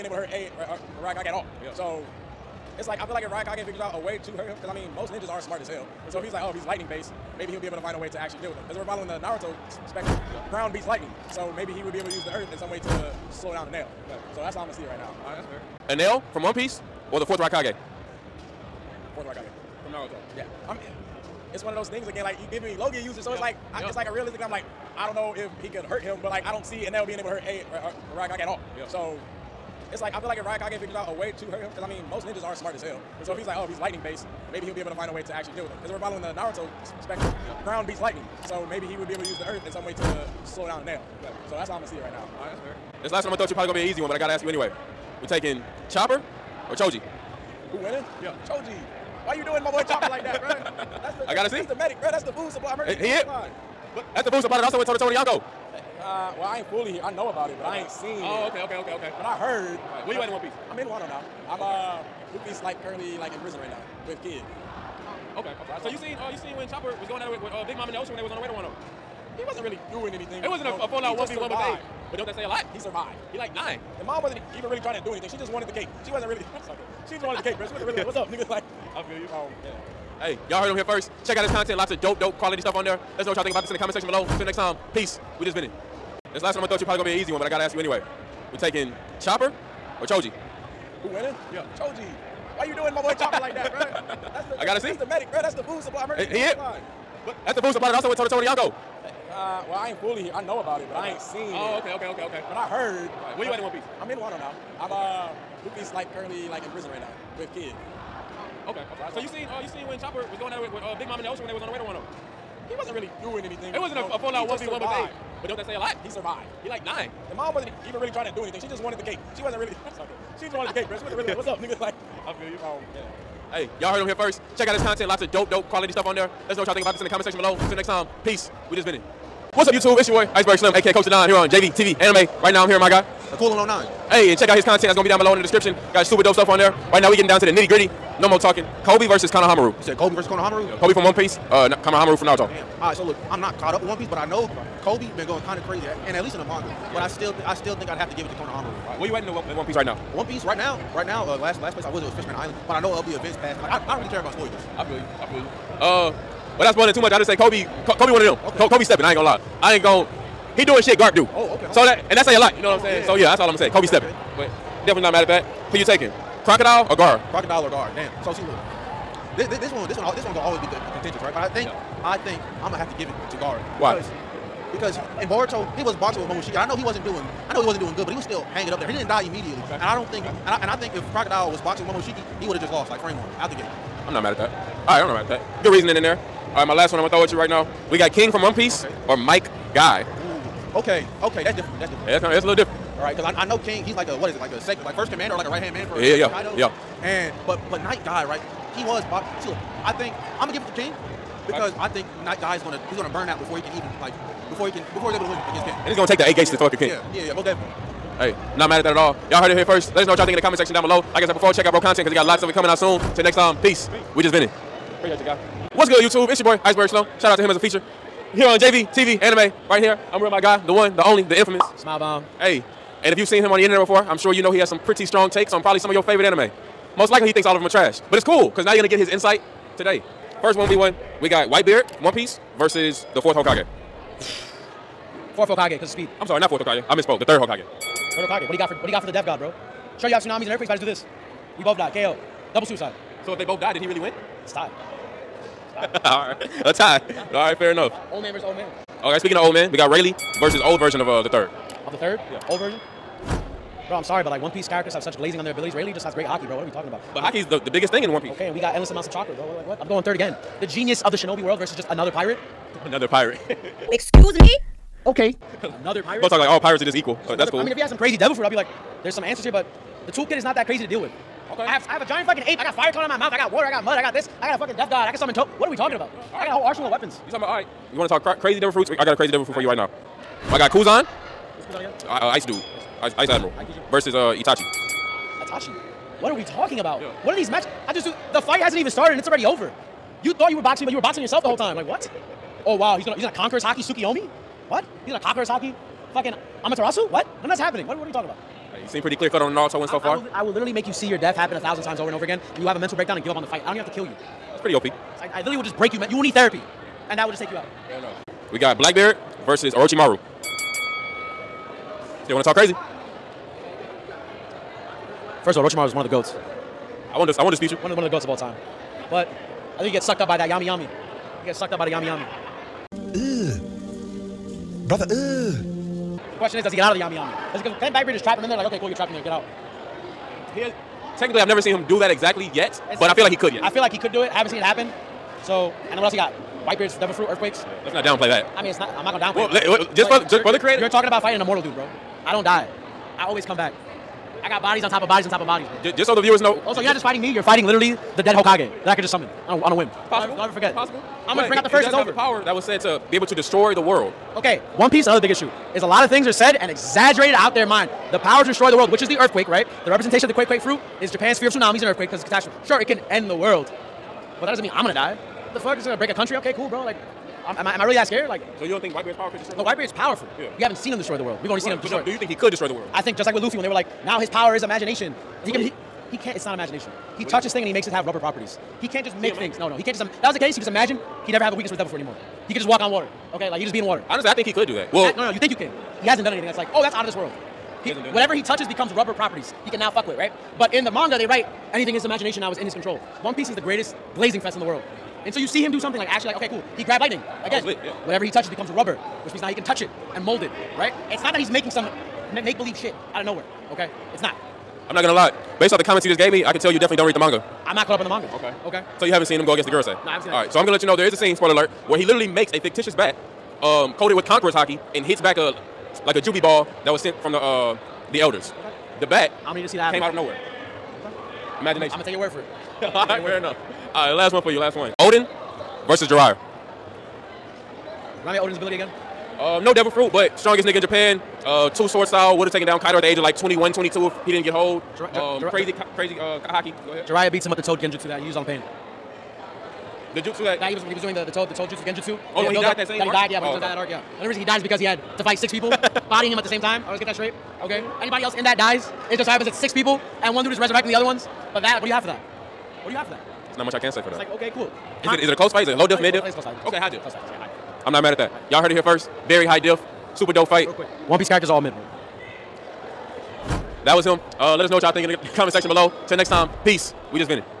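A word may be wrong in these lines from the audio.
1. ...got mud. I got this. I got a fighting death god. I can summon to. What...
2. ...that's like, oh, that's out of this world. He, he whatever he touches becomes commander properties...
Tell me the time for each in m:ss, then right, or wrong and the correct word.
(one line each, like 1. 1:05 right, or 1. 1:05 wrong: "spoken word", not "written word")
1. 4:33 wrong: "fucking", not "fighting"
2. 6:26 wrong: "rubber", not "commander".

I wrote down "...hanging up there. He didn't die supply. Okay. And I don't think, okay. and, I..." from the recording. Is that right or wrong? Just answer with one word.
wrong.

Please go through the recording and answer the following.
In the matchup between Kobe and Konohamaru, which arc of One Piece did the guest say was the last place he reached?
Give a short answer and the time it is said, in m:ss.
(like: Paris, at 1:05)
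Fishman Island, at 2:32.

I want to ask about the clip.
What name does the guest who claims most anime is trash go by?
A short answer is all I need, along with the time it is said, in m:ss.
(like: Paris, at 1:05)
Smile Bomb, at 3:41.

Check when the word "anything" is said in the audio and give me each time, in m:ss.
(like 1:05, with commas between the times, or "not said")
1:10, 1:15, 1:53, 1:58, 6:26, 6:31.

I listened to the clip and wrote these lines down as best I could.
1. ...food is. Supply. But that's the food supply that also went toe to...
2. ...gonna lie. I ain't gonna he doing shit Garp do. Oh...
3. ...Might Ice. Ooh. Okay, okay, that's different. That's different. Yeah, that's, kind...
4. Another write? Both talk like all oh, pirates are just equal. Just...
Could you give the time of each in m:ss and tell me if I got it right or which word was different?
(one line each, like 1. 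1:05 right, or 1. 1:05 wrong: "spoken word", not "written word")
1. 0:53 right
2. 2:39 right
3. 3:09 wrong: "Guy", not "Ice"
4. 4:25 wrong: "pirate", not "write".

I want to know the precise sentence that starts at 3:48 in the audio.
But it's cool because now you're gonna get his insight today.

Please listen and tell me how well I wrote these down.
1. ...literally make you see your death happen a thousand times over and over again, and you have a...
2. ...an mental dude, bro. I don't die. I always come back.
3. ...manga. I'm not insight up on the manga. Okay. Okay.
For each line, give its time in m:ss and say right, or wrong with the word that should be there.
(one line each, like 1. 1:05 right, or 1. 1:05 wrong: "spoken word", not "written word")
1. 5:00 right
2. 5:41 wrong: "immortal", not "mental"
3. 6:47 wrong: "caught", not "insight".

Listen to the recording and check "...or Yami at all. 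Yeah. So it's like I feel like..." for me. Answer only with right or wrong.
wrong.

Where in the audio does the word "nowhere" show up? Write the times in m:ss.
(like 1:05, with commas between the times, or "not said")
6:43, 7:00.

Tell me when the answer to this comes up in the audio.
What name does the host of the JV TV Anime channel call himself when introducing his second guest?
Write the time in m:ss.
3:36.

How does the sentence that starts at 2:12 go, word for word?
Right now, I'm here with my guy, Coolin 09.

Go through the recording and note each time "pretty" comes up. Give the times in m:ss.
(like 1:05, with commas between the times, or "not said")
3:44, 4:59, 5:04.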